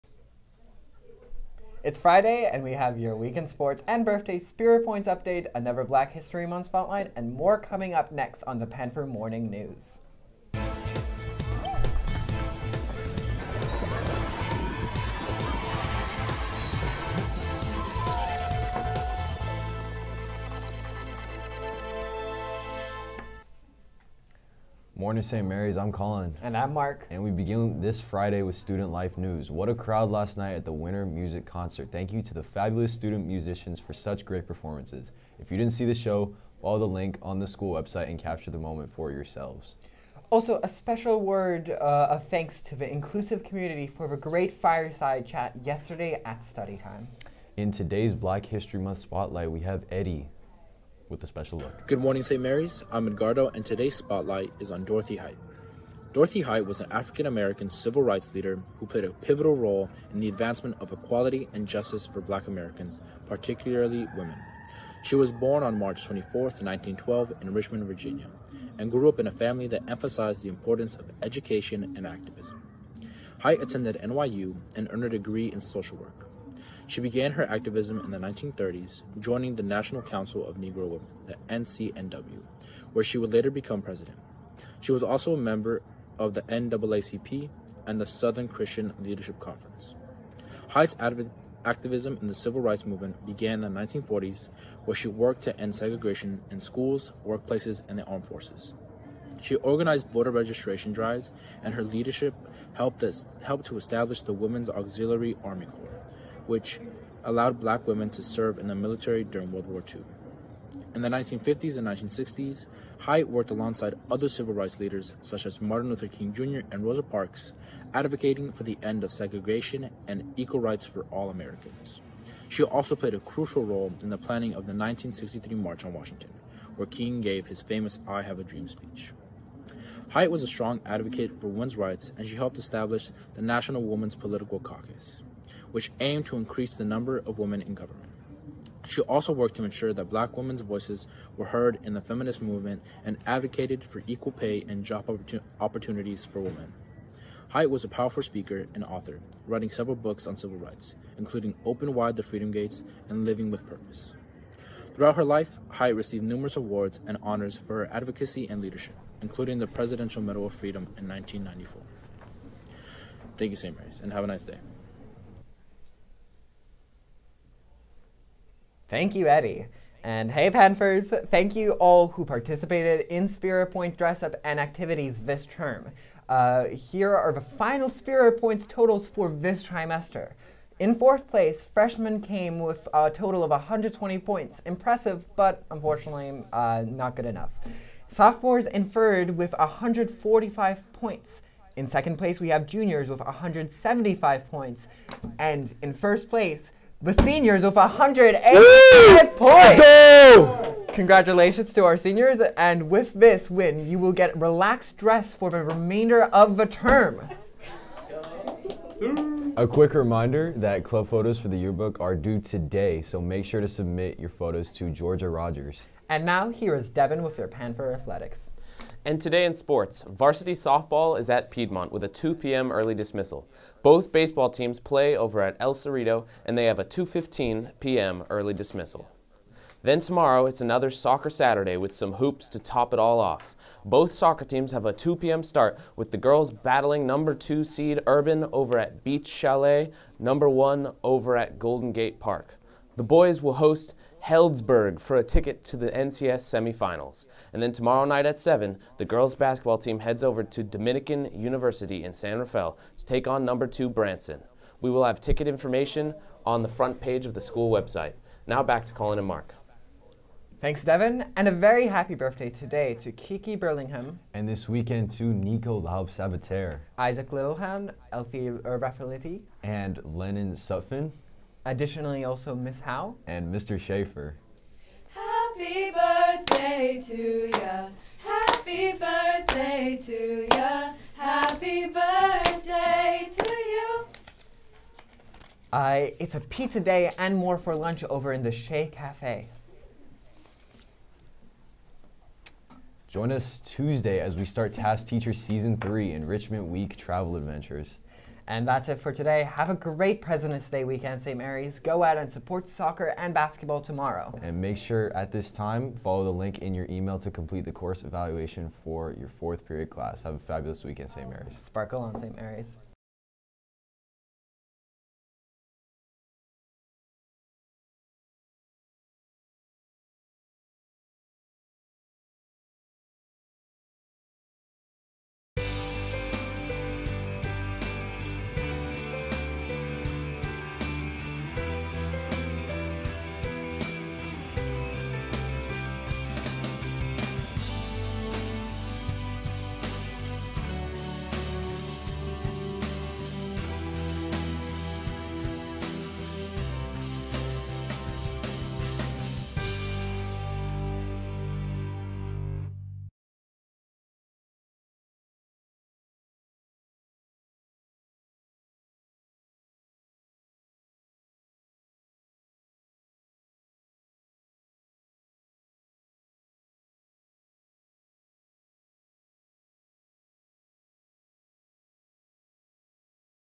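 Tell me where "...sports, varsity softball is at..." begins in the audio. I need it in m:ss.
3:39.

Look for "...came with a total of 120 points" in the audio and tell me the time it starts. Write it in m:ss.
3:02.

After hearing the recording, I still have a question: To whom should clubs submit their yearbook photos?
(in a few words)
Georgia Rogers.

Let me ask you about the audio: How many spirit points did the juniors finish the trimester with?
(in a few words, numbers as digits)
175.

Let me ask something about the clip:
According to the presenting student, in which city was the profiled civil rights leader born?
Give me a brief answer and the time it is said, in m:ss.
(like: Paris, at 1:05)
Richmond, Virginia, at 1:07.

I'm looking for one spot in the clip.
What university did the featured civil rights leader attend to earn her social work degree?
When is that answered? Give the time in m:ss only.
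1:14.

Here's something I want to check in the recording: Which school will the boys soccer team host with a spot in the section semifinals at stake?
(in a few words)
Healdsburg.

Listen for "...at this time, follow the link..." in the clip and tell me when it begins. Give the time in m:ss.
5:05.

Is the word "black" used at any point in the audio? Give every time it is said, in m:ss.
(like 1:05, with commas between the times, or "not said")
0:05, 0:48, 1:02, 1:47, 2:20.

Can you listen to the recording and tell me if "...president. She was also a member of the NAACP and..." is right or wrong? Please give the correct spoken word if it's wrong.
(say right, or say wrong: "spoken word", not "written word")
right.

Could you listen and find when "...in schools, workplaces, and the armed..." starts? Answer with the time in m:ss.
1:36.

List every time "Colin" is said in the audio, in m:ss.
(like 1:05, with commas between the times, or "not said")
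0:25, 4:18.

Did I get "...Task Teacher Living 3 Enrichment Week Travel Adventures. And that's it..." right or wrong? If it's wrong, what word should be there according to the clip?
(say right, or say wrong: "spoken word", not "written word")
wrong: "Season", not "Living".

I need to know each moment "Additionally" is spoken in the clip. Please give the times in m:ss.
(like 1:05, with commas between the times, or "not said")
4:31.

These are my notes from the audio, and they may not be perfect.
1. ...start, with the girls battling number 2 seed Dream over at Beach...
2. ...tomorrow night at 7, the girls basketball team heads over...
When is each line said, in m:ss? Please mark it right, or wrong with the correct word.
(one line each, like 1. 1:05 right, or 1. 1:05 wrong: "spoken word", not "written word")
1. 3:55 wrong: "Urban", not "Dream"
2. 4:07 right.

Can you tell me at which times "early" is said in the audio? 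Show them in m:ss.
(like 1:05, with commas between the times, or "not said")
3:42, 3:48.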